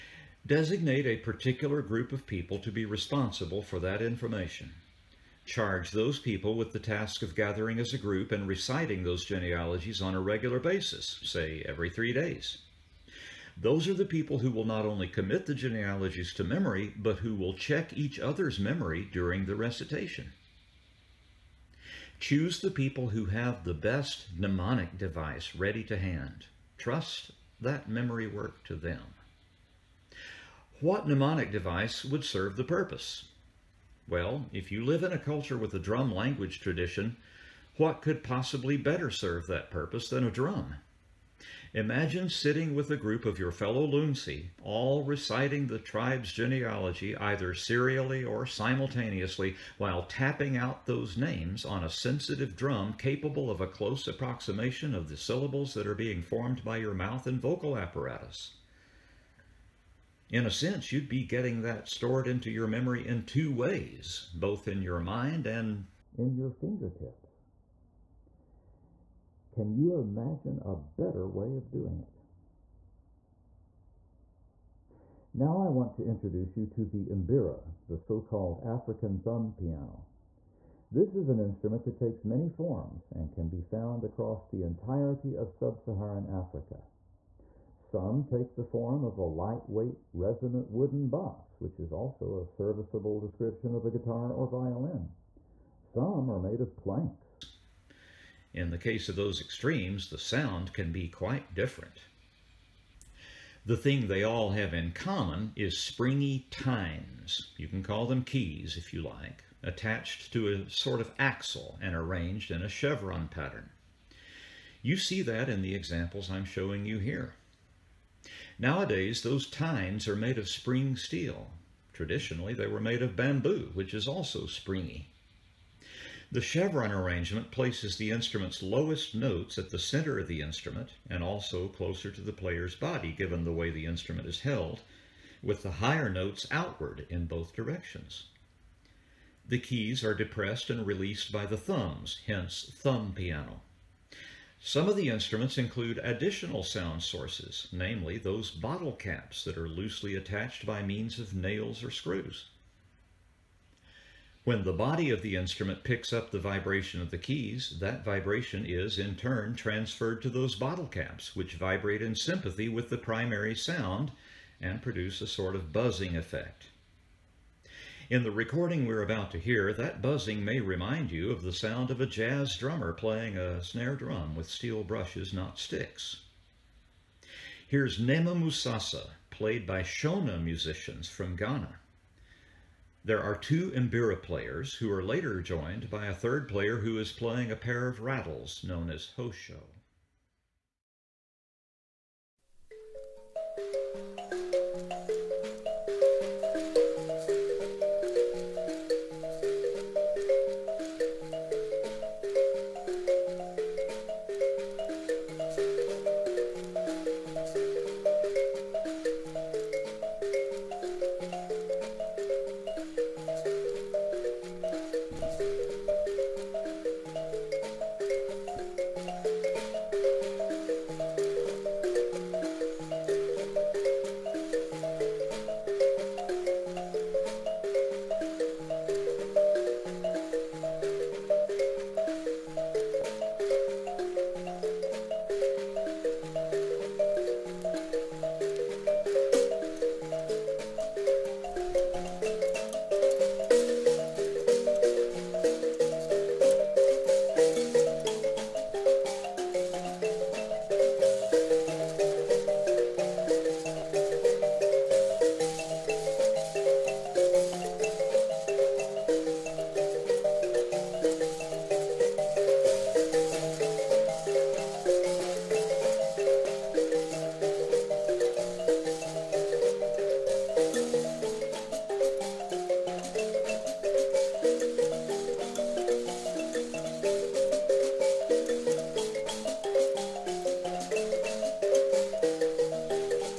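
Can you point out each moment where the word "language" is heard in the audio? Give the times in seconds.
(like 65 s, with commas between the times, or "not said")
36 s.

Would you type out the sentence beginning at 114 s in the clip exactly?
You see that in the examples I'm showing you here.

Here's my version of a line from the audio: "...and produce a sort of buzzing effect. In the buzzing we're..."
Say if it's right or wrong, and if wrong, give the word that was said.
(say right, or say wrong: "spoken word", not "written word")
wrong: "recording", not "buzzing".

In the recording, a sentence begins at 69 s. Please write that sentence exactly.
Can you imagine a better way of doing it?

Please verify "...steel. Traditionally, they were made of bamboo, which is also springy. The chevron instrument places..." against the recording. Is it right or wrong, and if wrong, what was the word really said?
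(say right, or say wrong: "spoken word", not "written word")
wrong: "arrangement", not "instrument".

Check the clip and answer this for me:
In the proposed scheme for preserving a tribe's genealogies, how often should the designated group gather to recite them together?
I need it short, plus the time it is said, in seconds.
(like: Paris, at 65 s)
every 3 days, at 11 s.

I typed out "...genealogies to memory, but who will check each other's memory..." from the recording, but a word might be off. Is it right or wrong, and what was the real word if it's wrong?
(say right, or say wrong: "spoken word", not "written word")
right.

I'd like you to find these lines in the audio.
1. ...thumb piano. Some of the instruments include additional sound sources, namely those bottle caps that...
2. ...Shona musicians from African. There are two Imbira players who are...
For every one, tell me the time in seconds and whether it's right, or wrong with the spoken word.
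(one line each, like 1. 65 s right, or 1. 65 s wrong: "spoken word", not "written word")
1. 142 s right
2. 179 s wrong: "Ghana", not "African".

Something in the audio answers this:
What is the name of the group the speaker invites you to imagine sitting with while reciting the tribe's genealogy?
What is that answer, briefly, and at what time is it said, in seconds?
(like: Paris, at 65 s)
Lunsi, at 43 s.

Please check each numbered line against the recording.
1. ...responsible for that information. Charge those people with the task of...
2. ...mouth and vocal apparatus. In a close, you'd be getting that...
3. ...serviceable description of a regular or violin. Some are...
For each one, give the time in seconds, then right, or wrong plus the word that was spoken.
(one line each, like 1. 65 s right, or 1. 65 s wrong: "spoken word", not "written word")
1. 2 s right
2. 56 s wrong: "sense", not "close"
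3. 92 s wrong: "guitar", not "regular".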